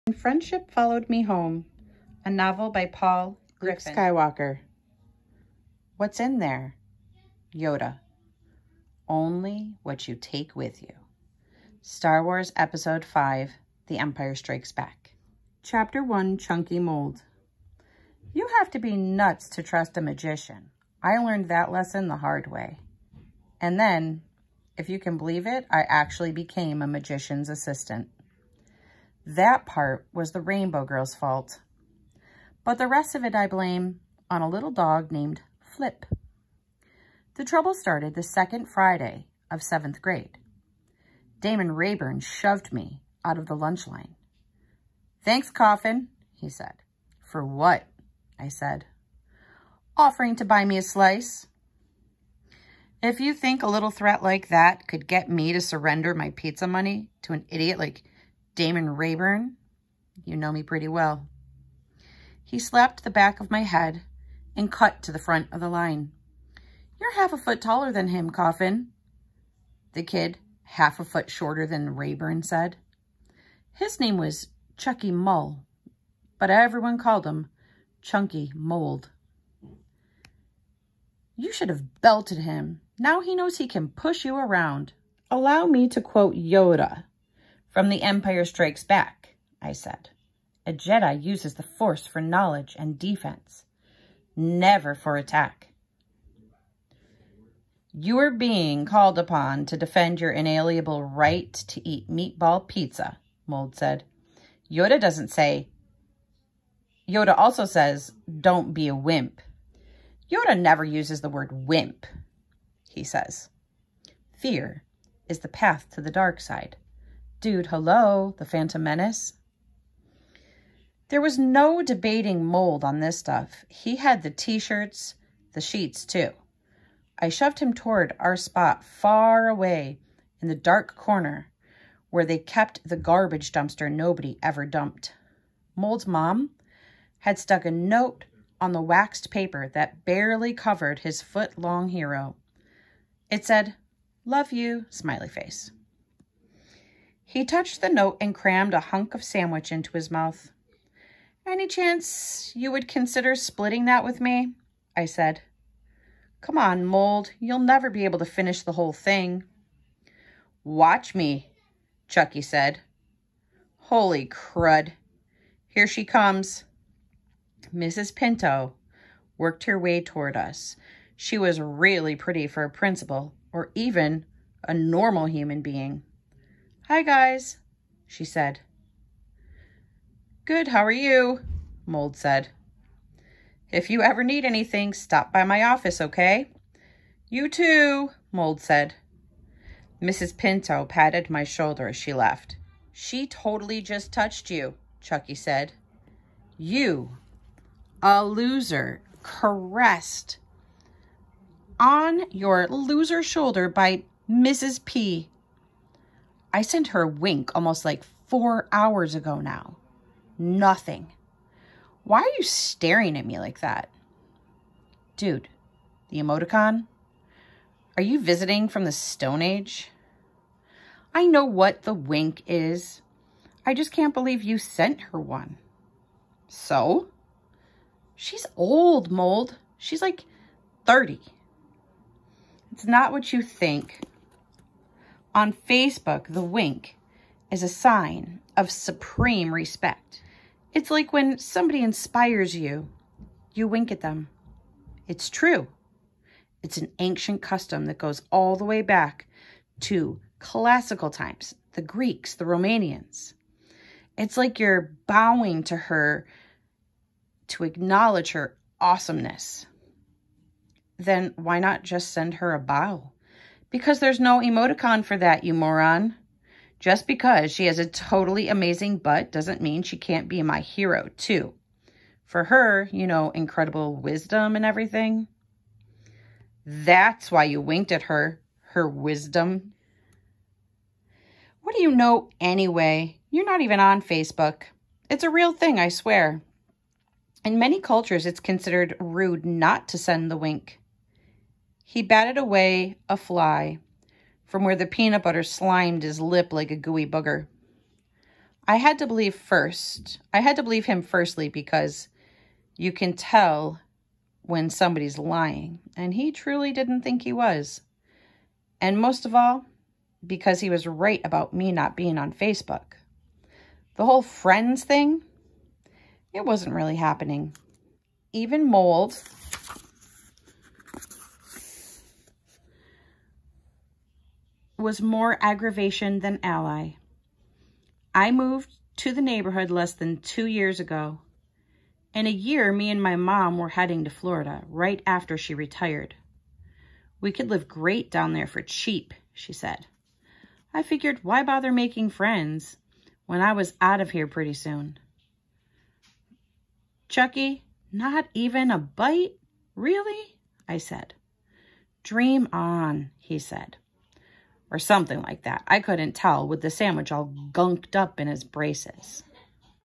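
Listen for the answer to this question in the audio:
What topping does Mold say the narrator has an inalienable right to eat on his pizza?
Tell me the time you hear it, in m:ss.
1:42.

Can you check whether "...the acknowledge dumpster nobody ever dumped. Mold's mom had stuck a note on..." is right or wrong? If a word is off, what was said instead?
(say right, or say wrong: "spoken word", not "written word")
wrong: "garbage", not "acknowledge".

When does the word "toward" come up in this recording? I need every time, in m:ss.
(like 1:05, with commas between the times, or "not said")
2:07, 2:50.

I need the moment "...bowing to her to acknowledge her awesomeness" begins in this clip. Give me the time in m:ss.
4:15.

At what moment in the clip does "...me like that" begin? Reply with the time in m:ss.
3:33.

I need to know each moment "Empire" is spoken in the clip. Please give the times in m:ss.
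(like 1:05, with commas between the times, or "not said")
0:13, 1:28.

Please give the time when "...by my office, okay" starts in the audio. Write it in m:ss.
3:05.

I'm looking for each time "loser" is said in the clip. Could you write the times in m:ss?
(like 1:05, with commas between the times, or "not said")
3:18, 3:22.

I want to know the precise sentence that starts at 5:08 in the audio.
And most of all, because he was right about me not being on Facebook.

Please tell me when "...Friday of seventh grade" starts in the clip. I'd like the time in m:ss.
0:38.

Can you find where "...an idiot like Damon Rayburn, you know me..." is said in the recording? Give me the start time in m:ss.
0:57.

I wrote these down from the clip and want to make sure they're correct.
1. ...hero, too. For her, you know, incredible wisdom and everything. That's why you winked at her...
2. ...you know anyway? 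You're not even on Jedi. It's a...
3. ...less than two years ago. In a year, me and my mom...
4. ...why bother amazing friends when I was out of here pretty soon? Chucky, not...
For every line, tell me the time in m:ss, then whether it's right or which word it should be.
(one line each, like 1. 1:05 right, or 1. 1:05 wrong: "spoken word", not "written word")
1. 4:30 right
2. 4:41 wrong: "Facebook", not "Jedi"
3. 5:29 right
4. 5:41 wrong: "making", not "amazing".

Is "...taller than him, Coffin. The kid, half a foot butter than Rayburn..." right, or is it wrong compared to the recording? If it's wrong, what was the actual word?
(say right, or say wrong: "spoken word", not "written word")
wrong: "shorter", not "butter".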